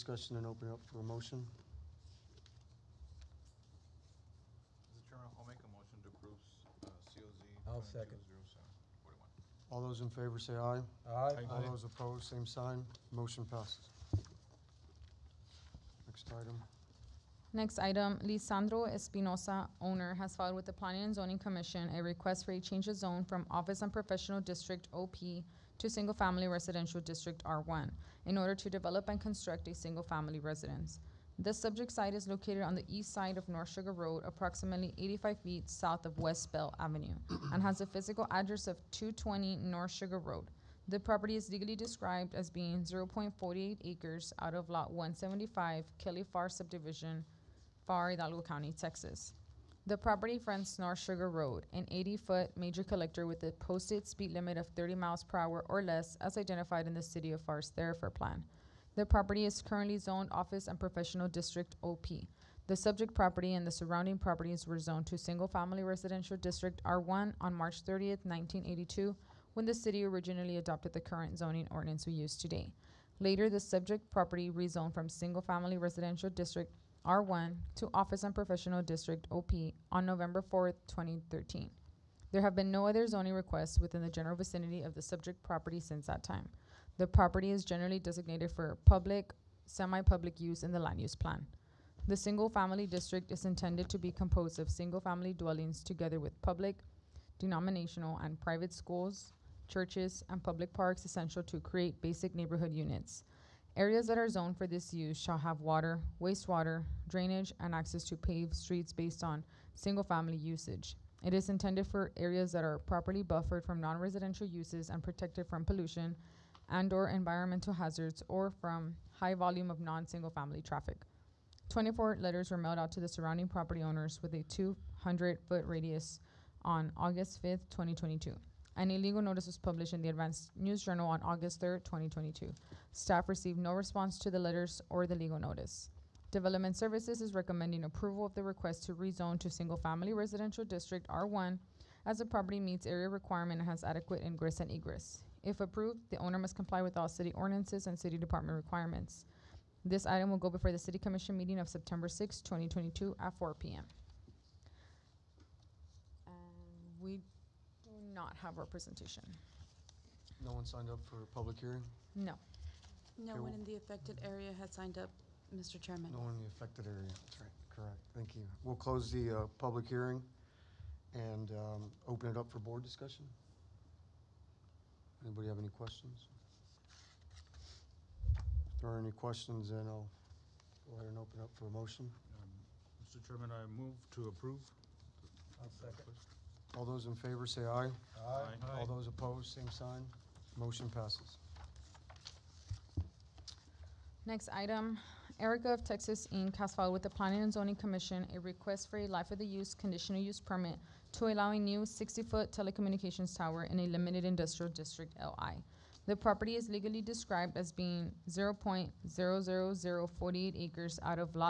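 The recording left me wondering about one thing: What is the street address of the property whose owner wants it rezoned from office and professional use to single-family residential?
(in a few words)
220 North Sugar Road.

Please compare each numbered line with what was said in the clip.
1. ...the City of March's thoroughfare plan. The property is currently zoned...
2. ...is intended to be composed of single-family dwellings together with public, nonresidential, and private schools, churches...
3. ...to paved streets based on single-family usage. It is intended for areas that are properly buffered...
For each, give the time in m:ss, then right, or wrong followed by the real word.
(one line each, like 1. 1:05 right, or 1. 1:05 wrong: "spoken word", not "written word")
1. 0:56 wrong: "Pharr", not "March"
2. 1:33 wrong: "denominational", not "nonresidential"
3. 1:48 right.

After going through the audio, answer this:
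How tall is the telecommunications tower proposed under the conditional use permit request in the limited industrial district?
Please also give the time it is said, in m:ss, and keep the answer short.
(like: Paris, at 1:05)
60 feet, at 3:21.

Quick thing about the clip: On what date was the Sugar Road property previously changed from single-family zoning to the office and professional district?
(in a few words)
November 4th, 2013.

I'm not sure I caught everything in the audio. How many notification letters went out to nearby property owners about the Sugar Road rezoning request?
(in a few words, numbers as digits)
24.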